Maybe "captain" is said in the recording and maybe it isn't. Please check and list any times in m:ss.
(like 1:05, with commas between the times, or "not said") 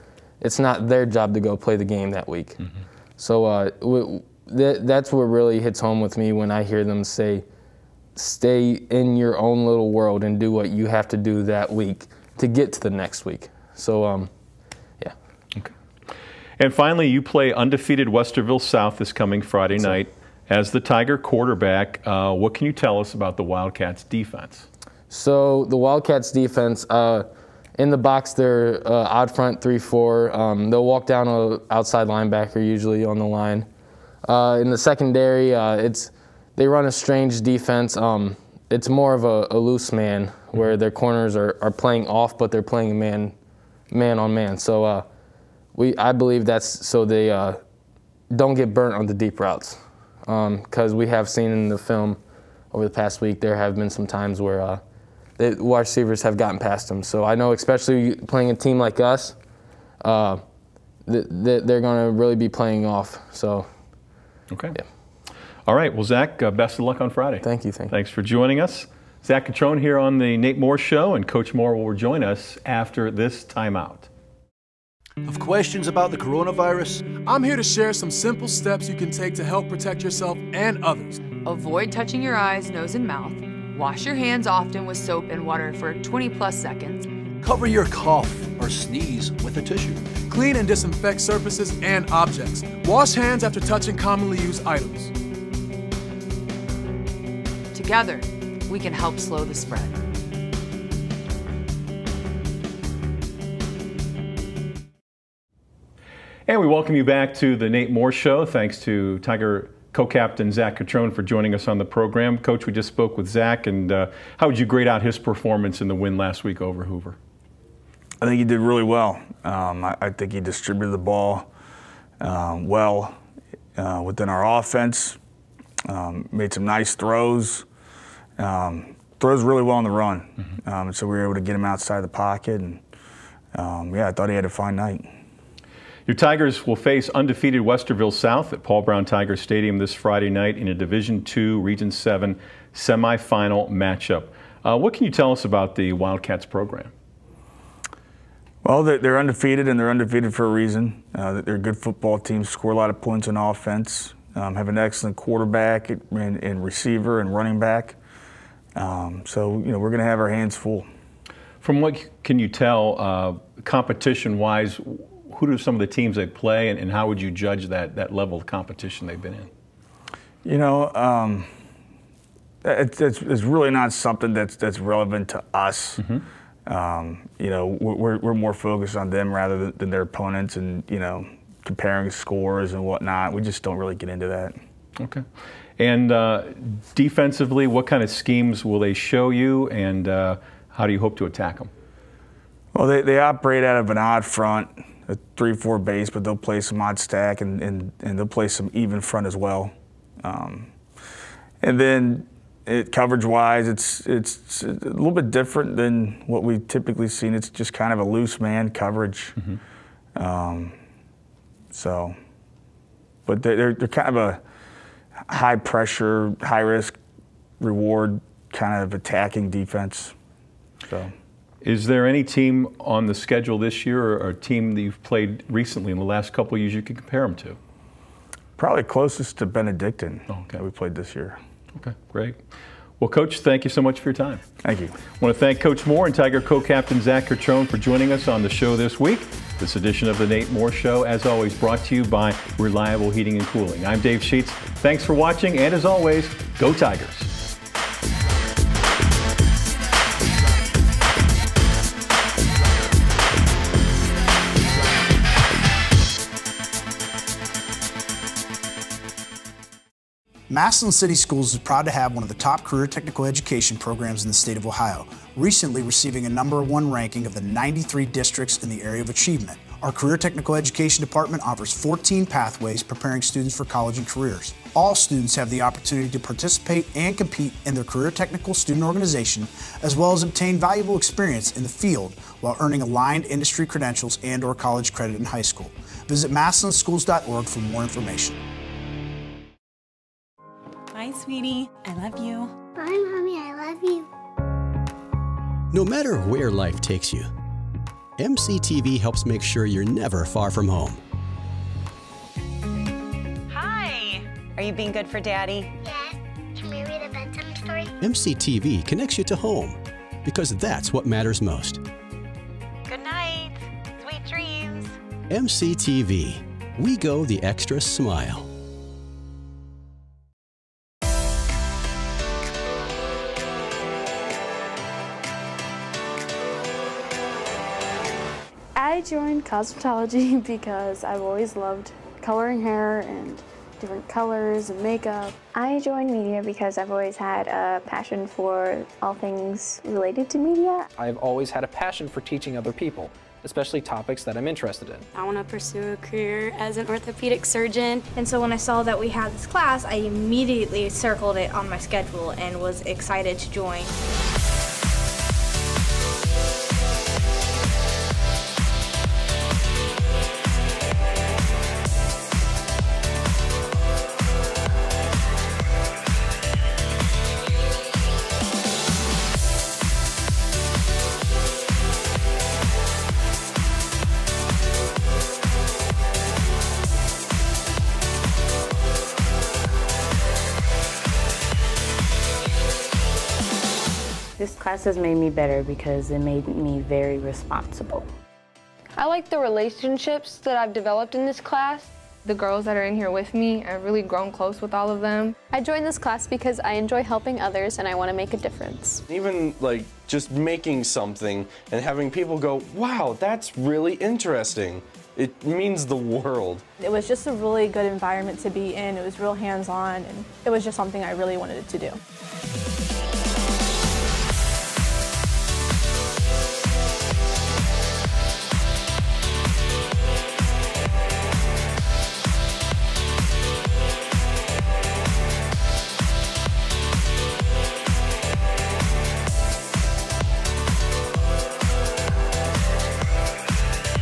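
1:49, 3:56.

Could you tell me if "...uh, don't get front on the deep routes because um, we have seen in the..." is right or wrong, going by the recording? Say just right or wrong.
wrong.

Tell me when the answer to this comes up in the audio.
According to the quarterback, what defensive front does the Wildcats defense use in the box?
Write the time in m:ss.
0:29.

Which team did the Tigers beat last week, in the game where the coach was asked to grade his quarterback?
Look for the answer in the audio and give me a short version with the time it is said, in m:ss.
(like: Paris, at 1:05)
Hoover, at 1:56.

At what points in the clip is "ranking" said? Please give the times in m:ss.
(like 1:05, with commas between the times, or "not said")
4:26.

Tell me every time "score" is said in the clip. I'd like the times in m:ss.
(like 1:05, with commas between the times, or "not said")
2:32, 3:02.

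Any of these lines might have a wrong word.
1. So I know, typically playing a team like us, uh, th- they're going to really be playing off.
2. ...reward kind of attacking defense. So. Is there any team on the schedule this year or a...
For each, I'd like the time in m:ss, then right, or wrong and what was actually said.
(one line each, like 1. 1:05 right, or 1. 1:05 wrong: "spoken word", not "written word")
1. 0:57 wrong: "especially", not "typically"
2. 3:37 right.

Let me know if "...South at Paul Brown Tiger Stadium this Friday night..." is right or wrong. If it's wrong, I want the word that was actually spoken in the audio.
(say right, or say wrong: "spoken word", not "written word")
right.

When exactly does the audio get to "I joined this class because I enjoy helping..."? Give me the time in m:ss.
6:35.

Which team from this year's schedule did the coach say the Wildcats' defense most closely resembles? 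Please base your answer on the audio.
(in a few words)
Benedictine.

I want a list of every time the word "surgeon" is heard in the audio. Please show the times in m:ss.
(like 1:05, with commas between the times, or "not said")
5:47.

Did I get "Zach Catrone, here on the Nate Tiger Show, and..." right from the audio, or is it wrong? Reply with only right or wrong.
wrong.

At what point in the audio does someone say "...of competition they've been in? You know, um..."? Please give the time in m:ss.
2:48.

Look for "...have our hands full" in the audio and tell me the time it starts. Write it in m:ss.
2:40.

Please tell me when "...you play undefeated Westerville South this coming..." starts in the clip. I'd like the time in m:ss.
0:17.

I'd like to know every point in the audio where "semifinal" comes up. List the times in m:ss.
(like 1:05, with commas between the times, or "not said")
2:22.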